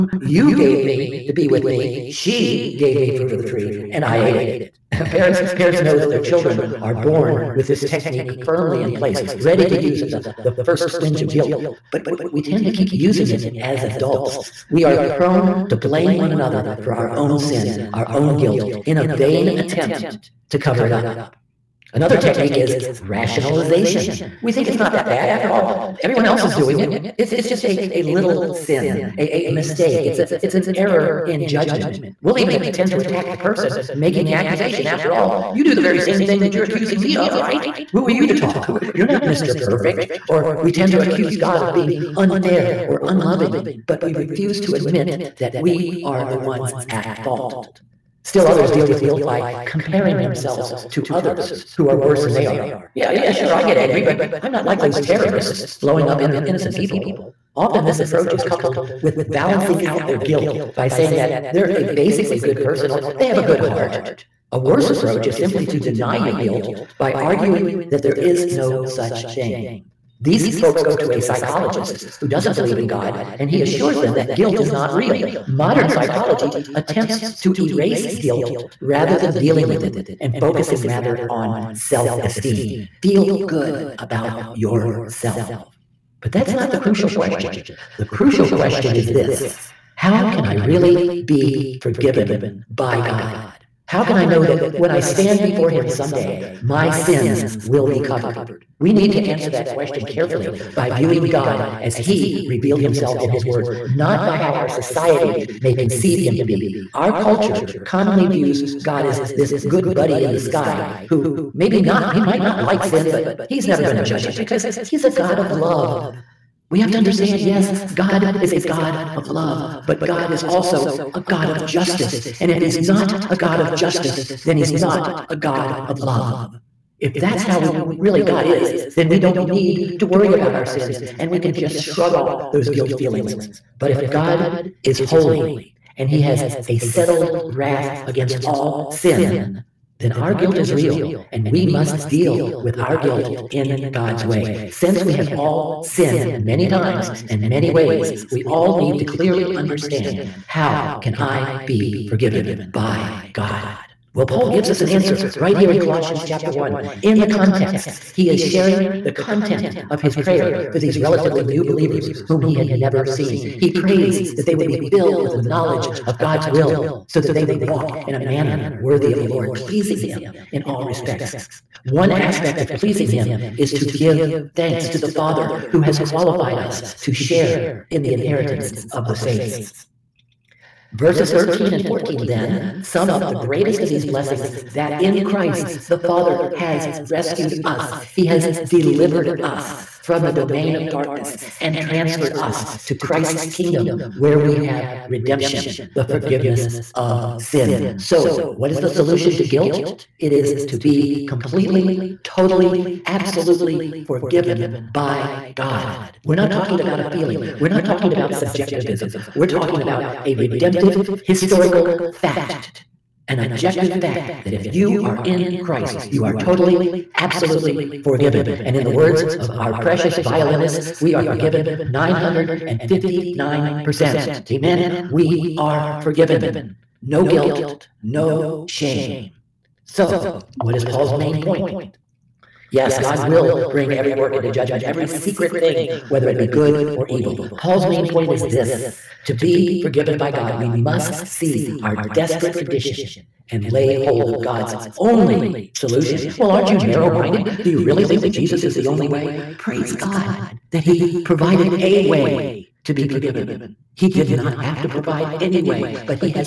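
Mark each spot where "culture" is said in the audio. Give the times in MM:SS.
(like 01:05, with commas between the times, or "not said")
01:47.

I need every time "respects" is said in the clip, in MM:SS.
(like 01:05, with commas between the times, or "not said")
02:50.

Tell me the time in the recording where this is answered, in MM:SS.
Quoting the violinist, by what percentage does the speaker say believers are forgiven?
03:41.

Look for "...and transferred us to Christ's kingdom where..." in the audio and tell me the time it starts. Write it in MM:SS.
03:11.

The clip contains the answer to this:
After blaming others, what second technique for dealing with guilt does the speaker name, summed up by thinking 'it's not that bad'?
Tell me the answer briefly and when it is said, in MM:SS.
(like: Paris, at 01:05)
Rationalization, at 00:22.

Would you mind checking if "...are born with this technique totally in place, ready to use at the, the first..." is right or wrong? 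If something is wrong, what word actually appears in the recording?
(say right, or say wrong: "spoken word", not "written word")
wrong: "firmly", not "totally".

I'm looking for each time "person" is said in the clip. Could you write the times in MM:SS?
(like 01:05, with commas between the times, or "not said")
00:33, 01:02.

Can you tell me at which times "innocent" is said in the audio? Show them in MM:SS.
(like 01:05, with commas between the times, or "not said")
00:56.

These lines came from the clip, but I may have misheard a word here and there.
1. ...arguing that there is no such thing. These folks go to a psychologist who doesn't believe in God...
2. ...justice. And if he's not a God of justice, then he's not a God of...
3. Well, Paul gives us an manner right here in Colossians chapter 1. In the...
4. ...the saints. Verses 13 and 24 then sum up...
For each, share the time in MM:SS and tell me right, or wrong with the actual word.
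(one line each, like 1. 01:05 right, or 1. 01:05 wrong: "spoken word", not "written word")
1. 01:07 right
2. 02:01 right
3. 02:34 wrong: "answer", not "manner"
4. 02:59 wrong: "14", not "24".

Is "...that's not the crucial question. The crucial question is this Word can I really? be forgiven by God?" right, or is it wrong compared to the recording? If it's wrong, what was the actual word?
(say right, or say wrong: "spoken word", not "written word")
wrong: "How", not "Word".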